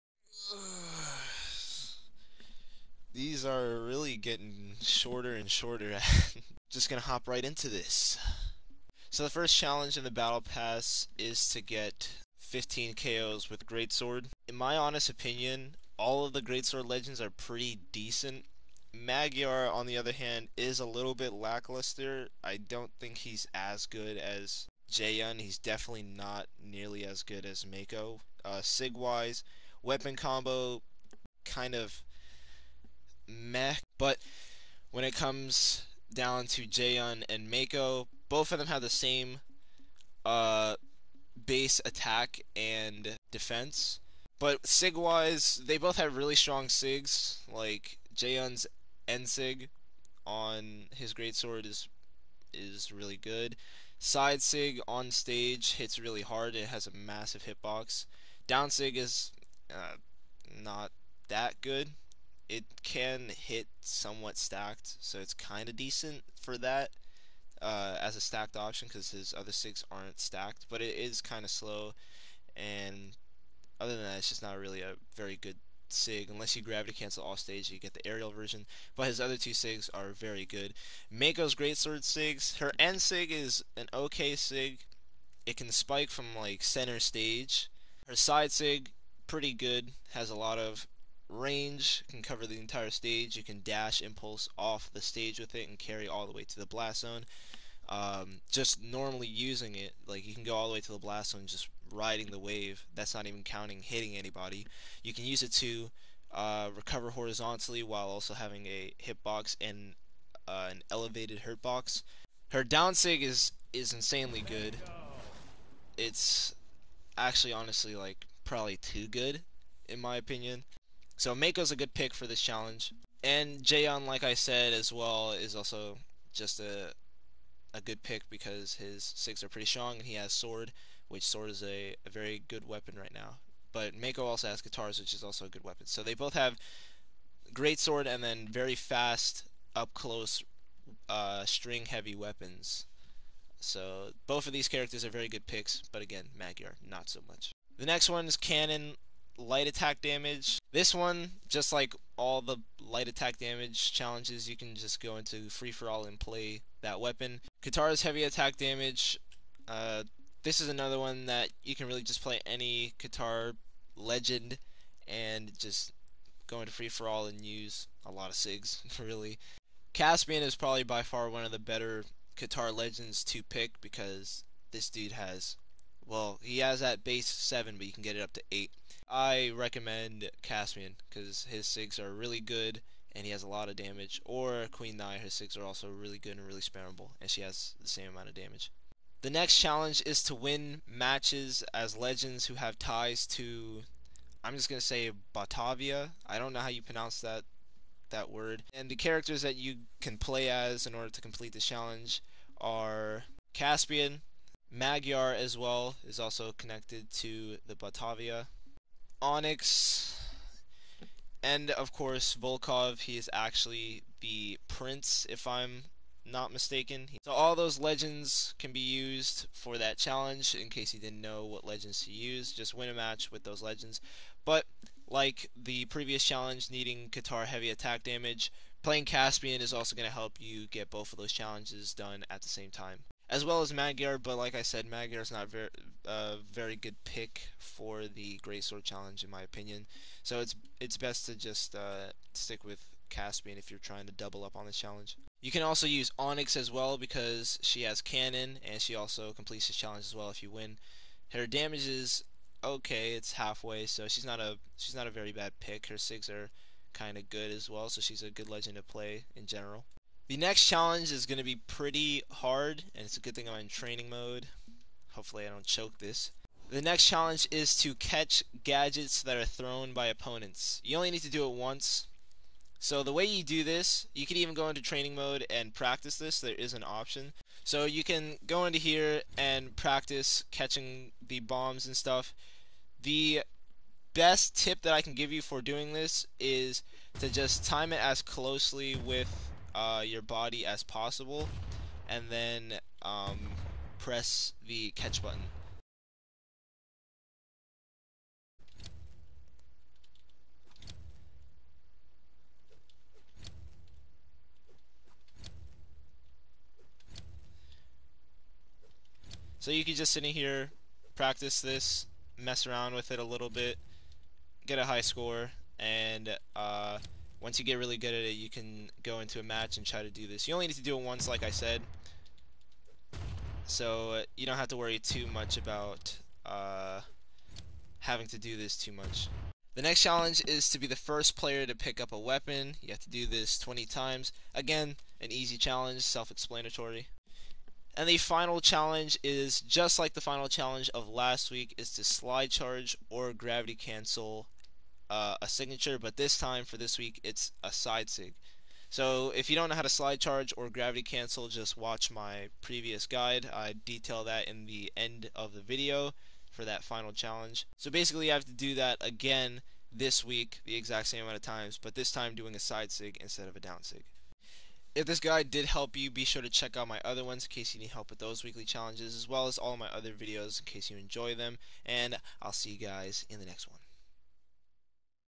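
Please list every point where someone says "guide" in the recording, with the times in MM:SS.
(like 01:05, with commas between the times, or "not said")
05:53, 06:05.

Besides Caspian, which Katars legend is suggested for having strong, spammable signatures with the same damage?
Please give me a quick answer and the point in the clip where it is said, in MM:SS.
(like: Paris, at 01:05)
Queen Nai, at 03:04.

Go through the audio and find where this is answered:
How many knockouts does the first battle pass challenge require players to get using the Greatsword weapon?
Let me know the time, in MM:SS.
00:12.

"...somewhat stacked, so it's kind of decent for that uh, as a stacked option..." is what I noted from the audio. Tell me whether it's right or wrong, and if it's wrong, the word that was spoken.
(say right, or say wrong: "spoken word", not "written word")
right.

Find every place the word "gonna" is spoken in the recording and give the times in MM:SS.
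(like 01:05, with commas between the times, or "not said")
00:06, 03:14.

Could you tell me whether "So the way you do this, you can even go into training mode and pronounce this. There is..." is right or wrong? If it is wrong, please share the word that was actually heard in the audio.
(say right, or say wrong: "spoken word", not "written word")
wrong: "practice", not "pronounce".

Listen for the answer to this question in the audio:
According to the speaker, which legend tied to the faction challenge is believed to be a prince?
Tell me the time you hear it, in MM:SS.
03:32.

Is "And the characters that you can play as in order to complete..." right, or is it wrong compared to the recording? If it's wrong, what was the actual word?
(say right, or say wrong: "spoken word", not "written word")
right.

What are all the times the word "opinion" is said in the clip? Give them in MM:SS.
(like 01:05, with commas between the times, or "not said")
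00:15, 02:00, 03:59.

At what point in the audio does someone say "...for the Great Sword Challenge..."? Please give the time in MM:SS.
03:57.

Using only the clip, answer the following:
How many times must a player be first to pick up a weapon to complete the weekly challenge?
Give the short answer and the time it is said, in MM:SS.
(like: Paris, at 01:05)
20, at 05:33.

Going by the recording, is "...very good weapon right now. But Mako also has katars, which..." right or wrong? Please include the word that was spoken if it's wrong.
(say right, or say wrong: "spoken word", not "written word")
right.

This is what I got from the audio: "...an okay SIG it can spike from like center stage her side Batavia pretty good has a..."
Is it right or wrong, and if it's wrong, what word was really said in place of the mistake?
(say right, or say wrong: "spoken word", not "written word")
wrong: "SIG", not "Batavia".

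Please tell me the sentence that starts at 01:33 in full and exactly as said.
You can dash impulse off the stage with it and carry all the way to the blast zone.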